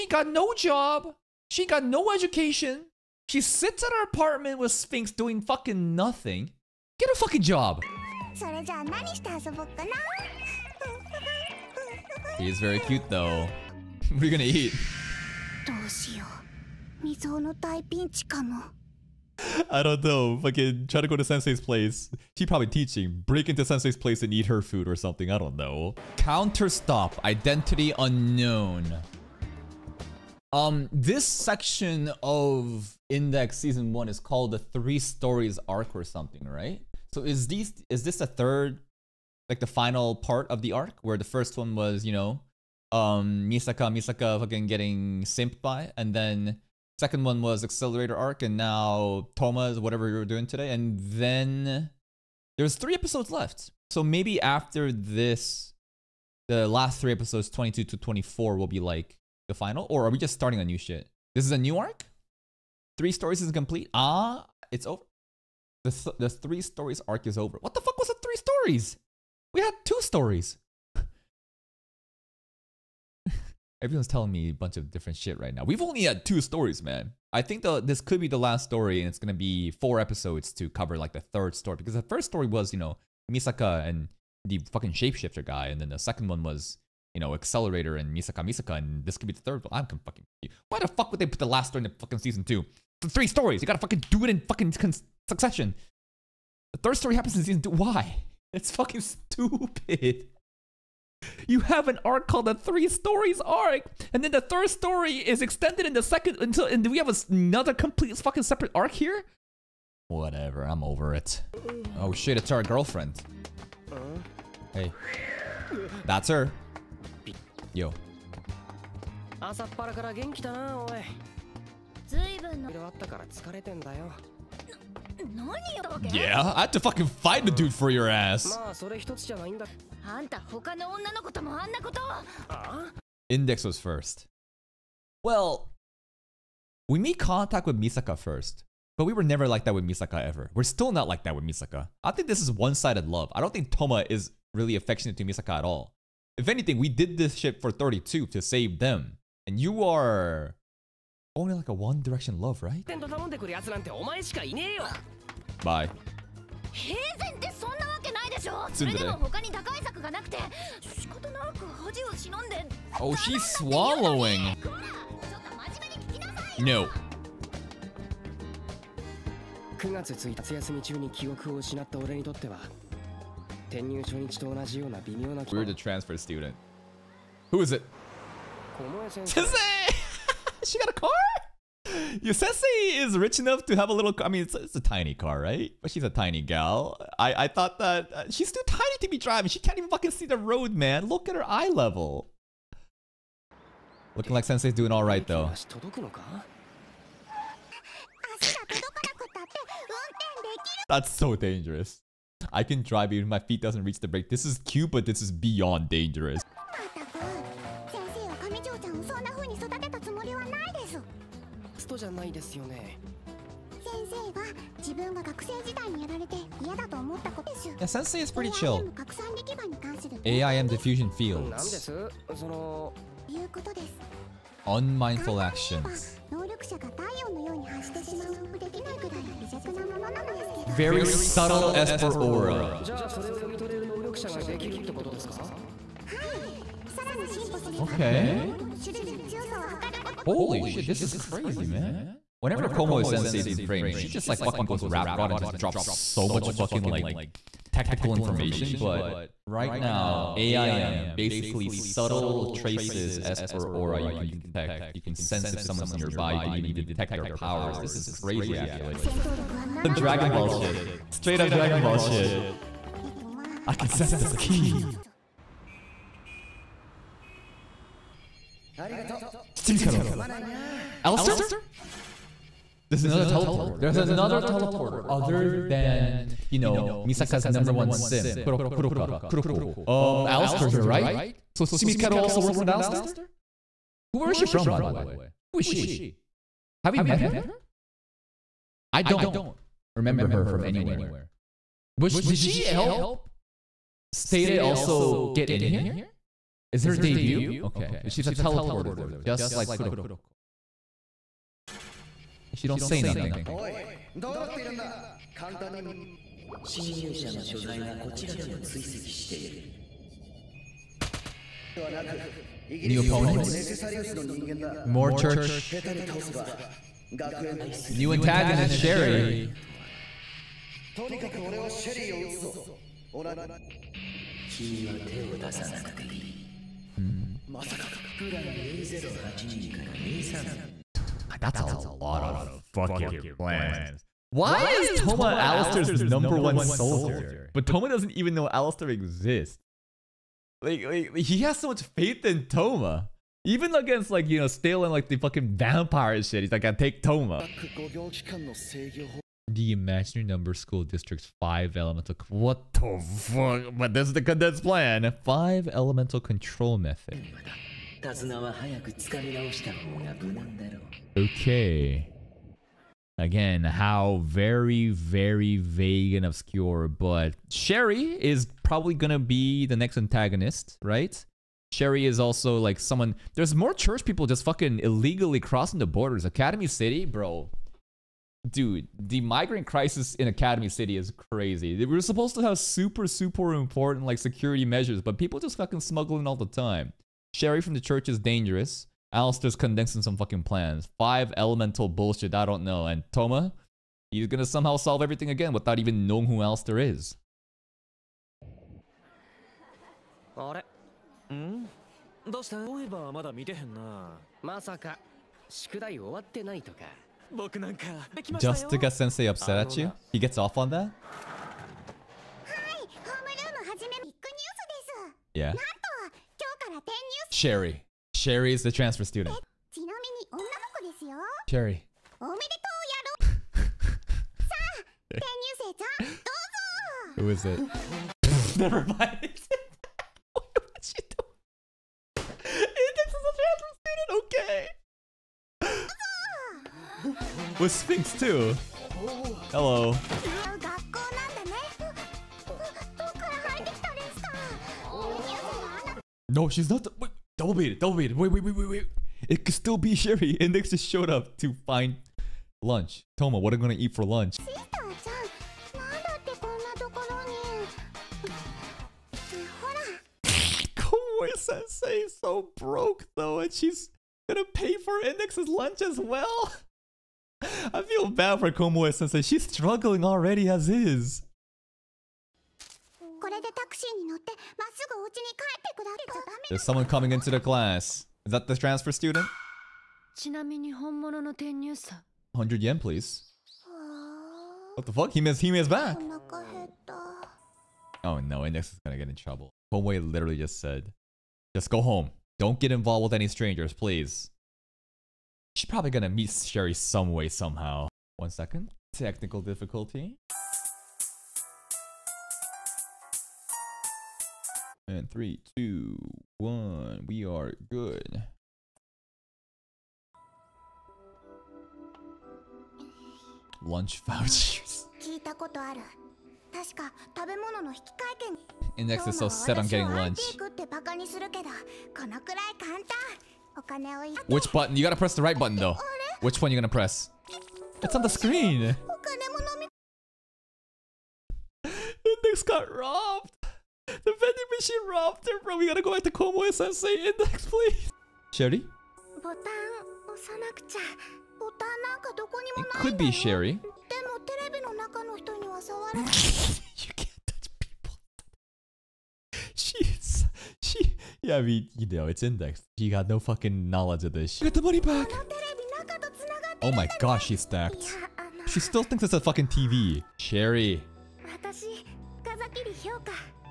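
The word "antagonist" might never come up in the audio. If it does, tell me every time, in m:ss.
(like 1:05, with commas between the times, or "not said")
5:18, 6:09.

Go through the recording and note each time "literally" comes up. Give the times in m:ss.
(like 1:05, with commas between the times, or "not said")
8:09.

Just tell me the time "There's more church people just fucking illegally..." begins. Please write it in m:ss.
6:13.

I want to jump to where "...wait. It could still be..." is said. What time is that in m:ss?
7:28.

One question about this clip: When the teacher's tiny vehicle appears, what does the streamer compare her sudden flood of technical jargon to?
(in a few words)
rap god.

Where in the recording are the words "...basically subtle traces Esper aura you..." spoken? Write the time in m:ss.
4:11.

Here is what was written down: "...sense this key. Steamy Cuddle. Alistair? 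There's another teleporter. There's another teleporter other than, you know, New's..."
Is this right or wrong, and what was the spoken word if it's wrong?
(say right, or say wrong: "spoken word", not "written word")
wrong: "Misaka", not "New".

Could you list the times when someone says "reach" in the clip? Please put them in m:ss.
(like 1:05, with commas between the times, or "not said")
3:23.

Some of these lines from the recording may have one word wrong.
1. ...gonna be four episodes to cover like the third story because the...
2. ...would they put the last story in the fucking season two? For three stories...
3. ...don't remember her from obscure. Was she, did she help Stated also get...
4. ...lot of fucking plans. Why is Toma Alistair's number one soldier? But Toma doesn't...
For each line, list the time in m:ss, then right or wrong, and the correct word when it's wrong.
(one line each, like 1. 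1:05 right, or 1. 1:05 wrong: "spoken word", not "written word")
1. 1:19 right
2. 1:31 right
3. 4:49 wrong: "anywhere", not "obscure"
4. 5:31 right.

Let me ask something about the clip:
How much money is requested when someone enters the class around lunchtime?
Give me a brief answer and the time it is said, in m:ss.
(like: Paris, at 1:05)
100 yen, at 8:00.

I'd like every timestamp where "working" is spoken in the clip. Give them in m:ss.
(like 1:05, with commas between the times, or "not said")
4:42.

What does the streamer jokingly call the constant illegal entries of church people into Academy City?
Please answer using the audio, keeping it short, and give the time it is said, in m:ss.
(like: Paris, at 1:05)
migrant crisis, at 6:19.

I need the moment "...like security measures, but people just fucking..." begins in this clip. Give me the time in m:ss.
6:24.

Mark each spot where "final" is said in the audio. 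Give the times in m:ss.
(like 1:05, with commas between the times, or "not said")
0:39, 0:59.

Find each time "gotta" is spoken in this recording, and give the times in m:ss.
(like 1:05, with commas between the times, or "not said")
1:33, 8:44, 8:55.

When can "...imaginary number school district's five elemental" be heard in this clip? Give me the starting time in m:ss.
5:49.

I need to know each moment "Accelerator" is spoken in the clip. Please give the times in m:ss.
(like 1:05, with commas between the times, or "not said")
0:47, 1:27.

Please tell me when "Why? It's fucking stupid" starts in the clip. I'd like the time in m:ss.
1:37.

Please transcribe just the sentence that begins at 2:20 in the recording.
We're still not like that with Misaka.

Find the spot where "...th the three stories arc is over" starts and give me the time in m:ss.
1:05.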